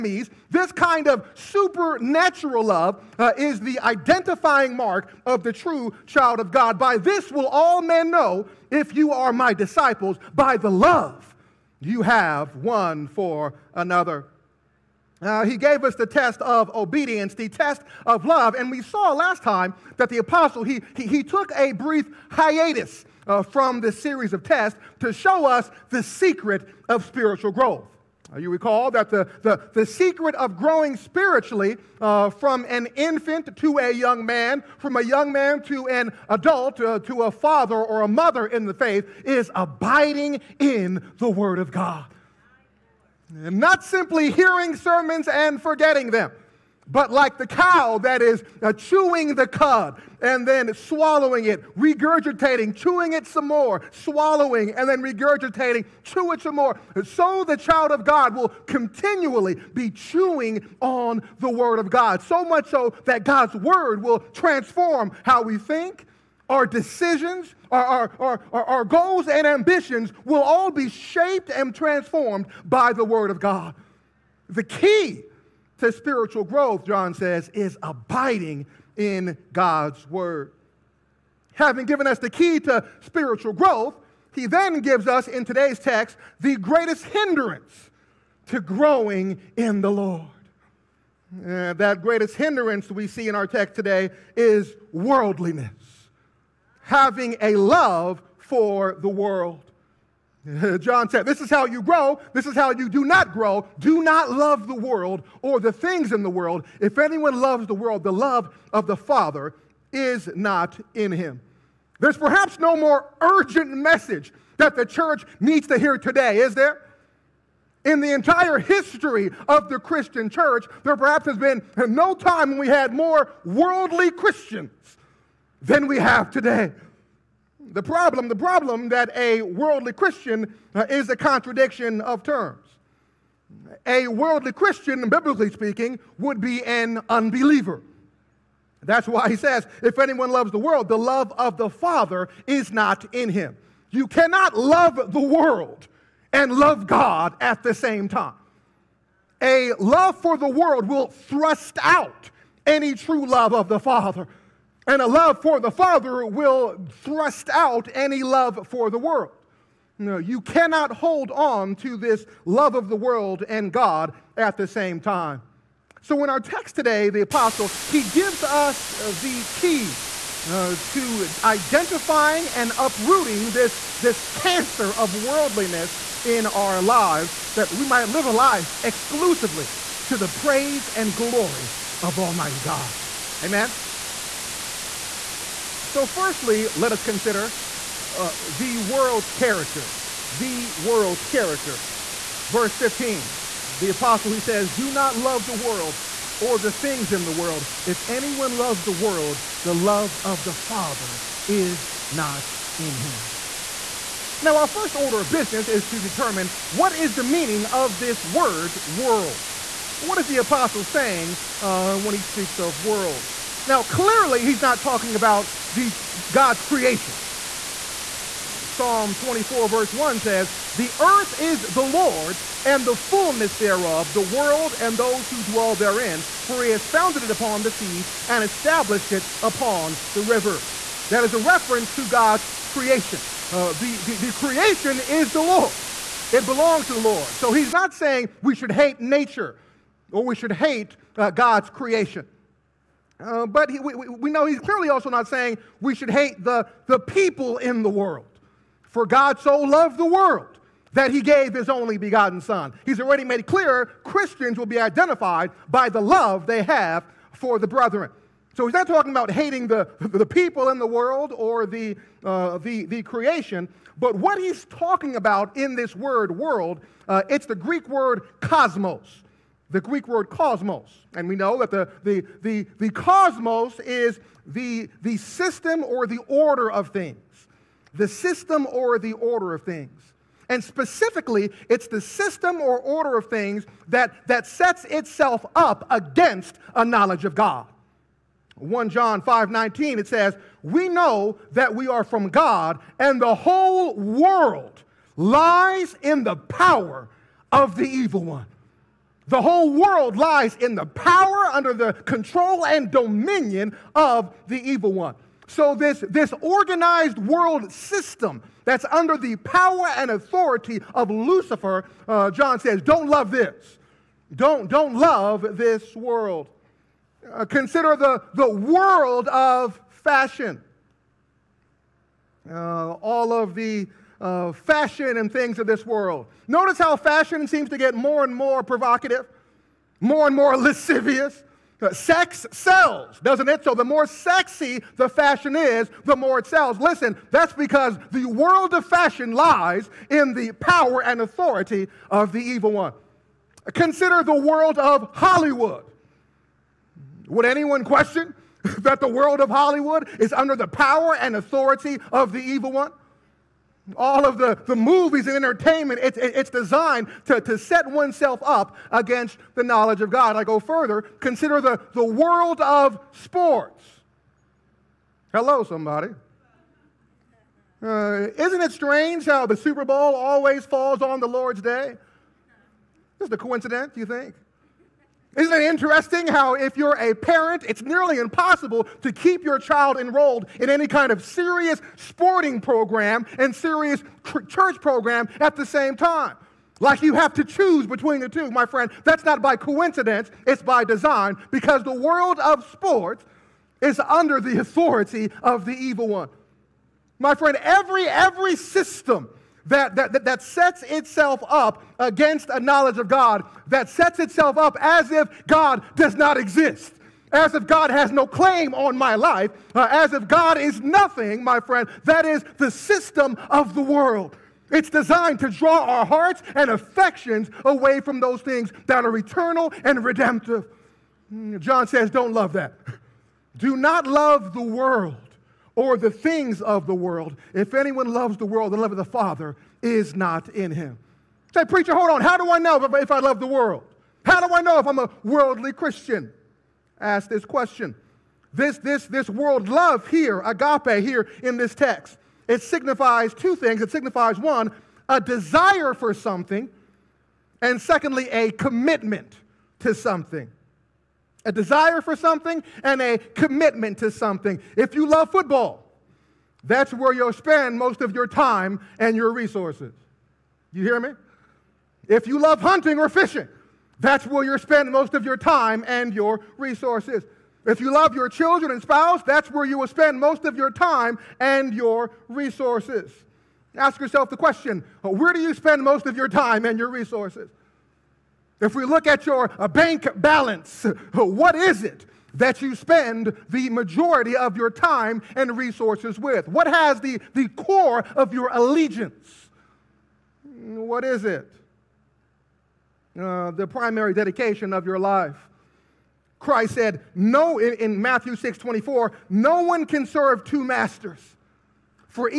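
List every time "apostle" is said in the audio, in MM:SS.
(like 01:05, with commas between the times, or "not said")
00:20, 02:47, 03:13, 03:30.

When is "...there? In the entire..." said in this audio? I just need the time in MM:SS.
01:56.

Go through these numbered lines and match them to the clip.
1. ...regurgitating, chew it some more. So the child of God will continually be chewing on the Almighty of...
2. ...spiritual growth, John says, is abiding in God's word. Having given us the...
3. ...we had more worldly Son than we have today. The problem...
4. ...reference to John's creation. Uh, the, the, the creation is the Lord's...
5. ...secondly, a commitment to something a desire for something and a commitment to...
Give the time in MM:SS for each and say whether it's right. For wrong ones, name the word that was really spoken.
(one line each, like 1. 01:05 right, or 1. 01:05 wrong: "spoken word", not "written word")
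1. 00:54 wrong: "Word", not "Almighty"
2. 01:15 right
3. 02:02 wrong: "Christians", not "Son"
4. 03:51 wrong: "God", not "John"
5. 07:27 right.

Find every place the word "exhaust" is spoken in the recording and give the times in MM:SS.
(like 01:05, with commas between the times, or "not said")
not said.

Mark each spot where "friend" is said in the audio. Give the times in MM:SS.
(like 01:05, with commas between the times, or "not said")
06:28, 06:37, 06:51.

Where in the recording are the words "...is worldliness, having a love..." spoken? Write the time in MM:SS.
01:34.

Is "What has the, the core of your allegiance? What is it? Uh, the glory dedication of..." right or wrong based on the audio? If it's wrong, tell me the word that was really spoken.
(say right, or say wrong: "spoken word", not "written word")
wrong: "primary", not "glory".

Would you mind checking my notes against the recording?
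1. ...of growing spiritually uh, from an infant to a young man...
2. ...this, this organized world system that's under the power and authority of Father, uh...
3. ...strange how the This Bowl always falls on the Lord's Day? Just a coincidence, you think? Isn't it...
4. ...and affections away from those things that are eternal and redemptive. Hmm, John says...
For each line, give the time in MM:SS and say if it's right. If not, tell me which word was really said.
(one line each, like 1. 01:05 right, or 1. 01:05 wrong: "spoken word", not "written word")
1. 00:30 right
2. 05:05 wrong: "Lucifer", not "Father"
3. 06:08 wrong: "Super", not "This"
4. 06:56 right.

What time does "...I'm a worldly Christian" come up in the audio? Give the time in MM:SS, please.
07:14.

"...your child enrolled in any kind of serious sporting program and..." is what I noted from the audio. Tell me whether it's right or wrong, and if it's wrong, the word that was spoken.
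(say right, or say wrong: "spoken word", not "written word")
right.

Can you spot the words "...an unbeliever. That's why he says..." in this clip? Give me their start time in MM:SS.
02:16.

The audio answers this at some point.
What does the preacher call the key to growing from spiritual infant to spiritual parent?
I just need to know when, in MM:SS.
00:39.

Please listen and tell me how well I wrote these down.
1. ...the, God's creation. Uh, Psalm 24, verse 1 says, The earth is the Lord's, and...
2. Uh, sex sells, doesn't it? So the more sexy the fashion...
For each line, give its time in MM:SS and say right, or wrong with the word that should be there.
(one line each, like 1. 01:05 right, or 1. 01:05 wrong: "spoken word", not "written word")
1. 03:35 right
2. 05:31 right.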